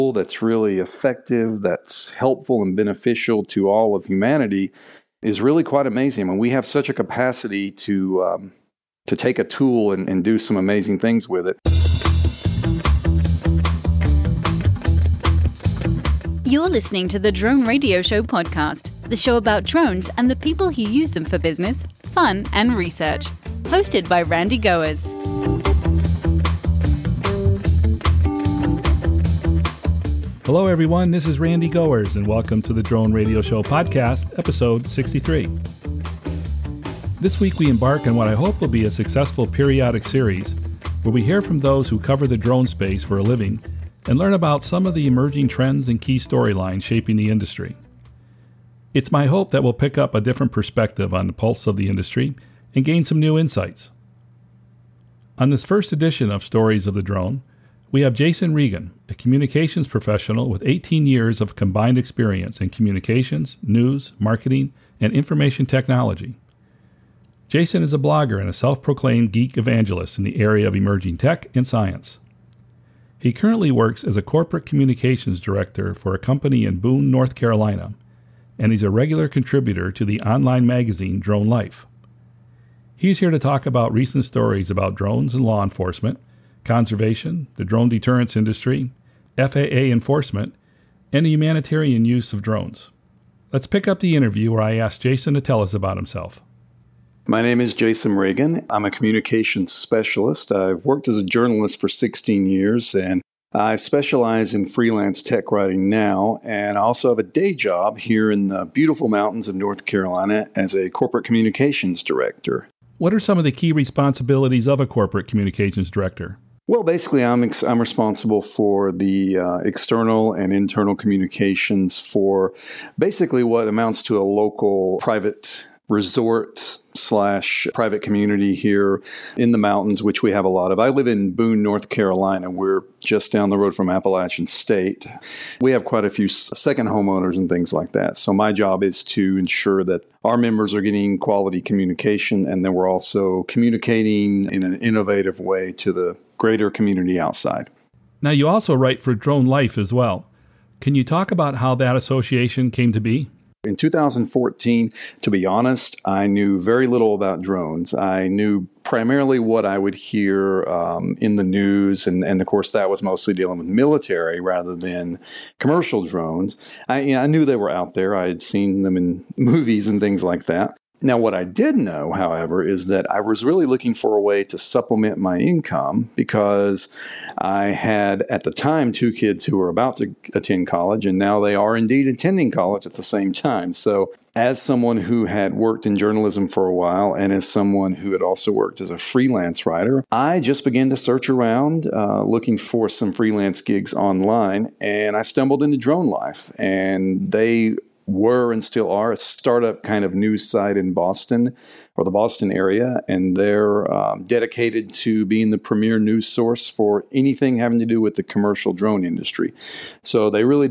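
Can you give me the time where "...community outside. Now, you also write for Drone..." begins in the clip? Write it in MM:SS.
02:26.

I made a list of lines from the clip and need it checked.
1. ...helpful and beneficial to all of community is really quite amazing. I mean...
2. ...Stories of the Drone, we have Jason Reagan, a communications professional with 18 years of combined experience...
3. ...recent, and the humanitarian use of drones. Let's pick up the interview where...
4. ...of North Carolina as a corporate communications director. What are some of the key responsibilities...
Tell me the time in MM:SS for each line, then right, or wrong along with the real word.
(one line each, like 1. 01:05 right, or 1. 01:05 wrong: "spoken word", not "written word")
1. 00:02 wrong: "humanity", not "community"
2. 00:56 right
3. 01:29 wrong: "enforcement", not "recent"
4. 01:49 right.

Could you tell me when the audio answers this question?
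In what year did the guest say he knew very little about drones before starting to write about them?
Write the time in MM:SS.
02:33.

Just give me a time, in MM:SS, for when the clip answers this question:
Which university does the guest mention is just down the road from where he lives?
02:13.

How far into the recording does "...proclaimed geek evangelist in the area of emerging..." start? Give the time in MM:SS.
01:08.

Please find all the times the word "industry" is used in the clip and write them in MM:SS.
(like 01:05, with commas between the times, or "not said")
00:47, 00:51, 01:28, 03:29.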